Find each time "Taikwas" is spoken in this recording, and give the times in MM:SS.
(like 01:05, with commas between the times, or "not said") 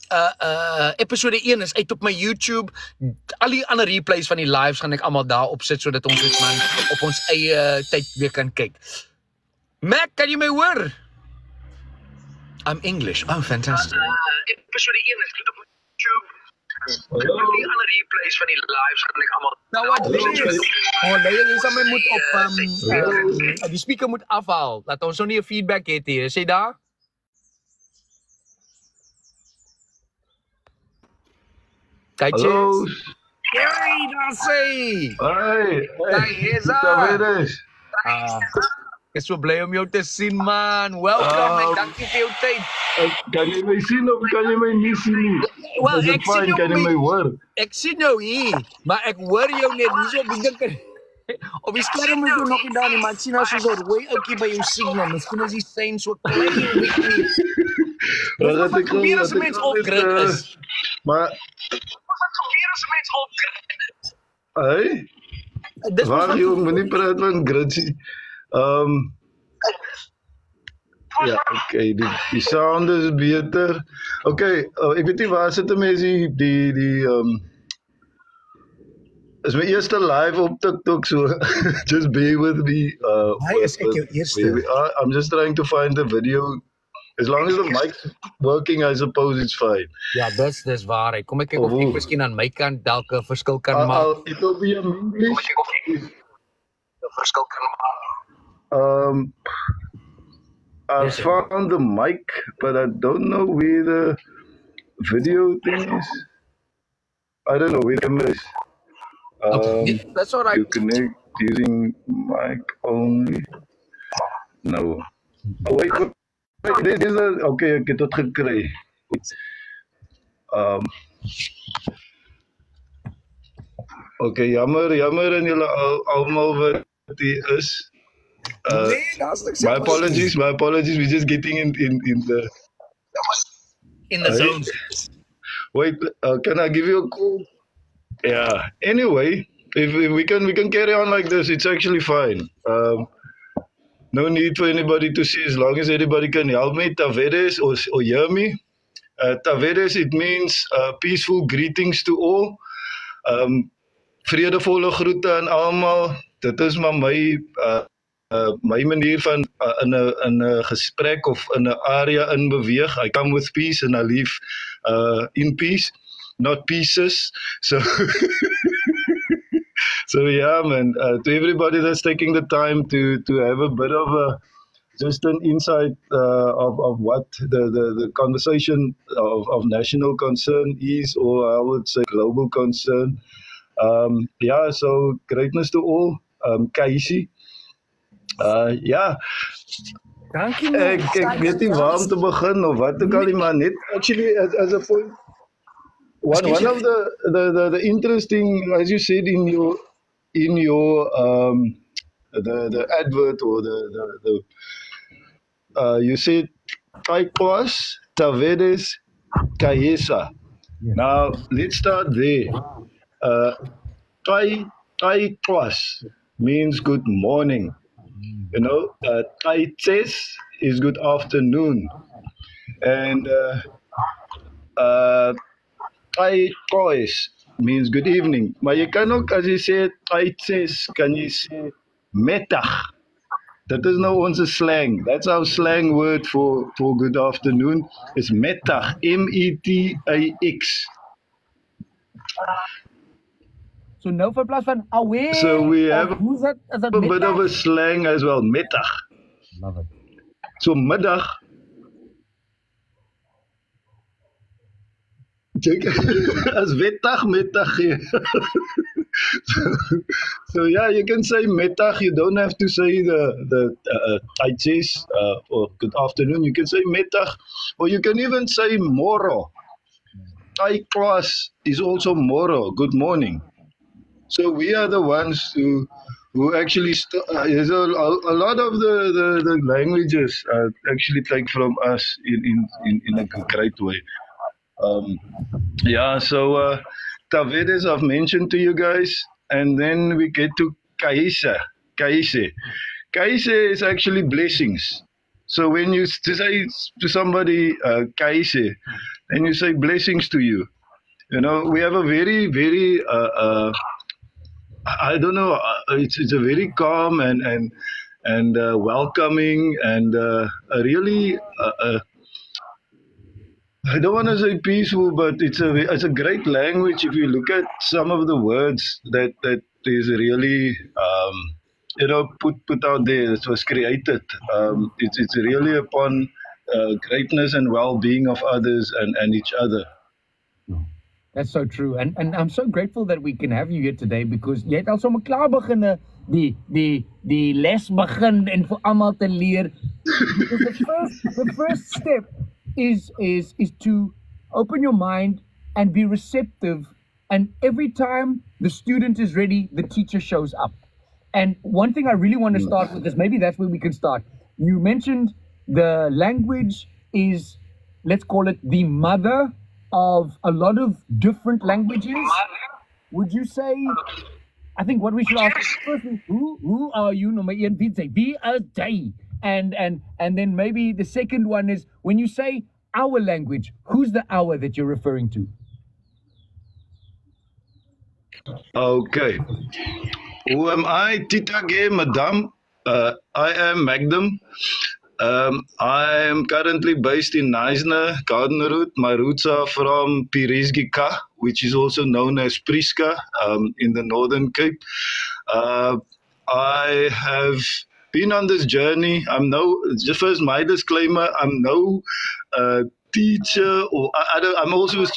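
03:27, 03:35.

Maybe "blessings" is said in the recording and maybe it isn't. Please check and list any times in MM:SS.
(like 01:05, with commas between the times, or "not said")
04:54, 04:59.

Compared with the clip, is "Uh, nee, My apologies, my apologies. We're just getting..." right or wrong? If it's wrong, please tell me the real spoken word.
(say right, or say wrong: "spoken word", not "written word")
right.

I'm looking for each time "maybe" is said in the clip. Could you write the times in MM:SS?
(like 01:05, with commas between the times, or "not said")
05:53, 06:10.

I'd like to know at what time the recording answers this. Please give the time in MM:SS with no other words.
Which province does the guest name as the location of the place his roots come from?
06:34.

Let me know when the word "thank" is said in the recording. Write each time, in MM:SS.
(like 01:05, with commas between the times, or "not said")
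00:41.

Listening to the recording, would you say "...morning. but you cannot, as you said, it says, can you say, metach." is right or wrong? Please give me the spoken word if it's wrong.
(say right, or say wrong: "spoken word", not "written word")
wrong: "evening", not "morning".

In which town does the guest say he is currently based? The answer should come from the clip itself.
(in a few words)
Knysna.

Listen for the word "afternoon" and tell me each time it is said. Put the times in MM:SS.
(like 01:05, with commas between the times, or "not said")
03:41, 03:57, 04:26.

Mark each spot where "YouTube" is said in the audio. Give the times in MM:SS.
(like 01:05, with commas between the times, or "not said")
00:02, 00:15.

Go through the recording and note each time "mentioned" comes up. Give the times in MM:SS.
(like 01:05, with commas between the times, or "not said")
04:48, 05:54.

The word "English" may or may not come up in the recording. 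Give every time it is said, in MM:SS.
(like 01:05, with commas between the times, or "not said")
00:12, 01:34.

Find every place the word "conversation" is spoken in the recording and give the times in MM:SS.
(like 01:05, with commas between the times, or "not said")
02:58.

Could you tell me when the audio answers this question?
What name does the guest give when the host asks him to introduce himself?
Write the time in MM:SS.
06:23.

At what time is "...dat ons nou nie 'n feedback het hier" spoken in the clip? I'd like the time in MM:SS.
00:24.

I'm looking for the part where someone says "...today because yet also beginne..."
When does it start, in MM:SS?
05:33.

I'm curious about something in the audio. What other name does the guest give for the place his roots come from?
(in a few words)
Prieska.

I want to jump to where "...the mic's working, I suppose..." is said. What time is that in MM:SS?
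01:27.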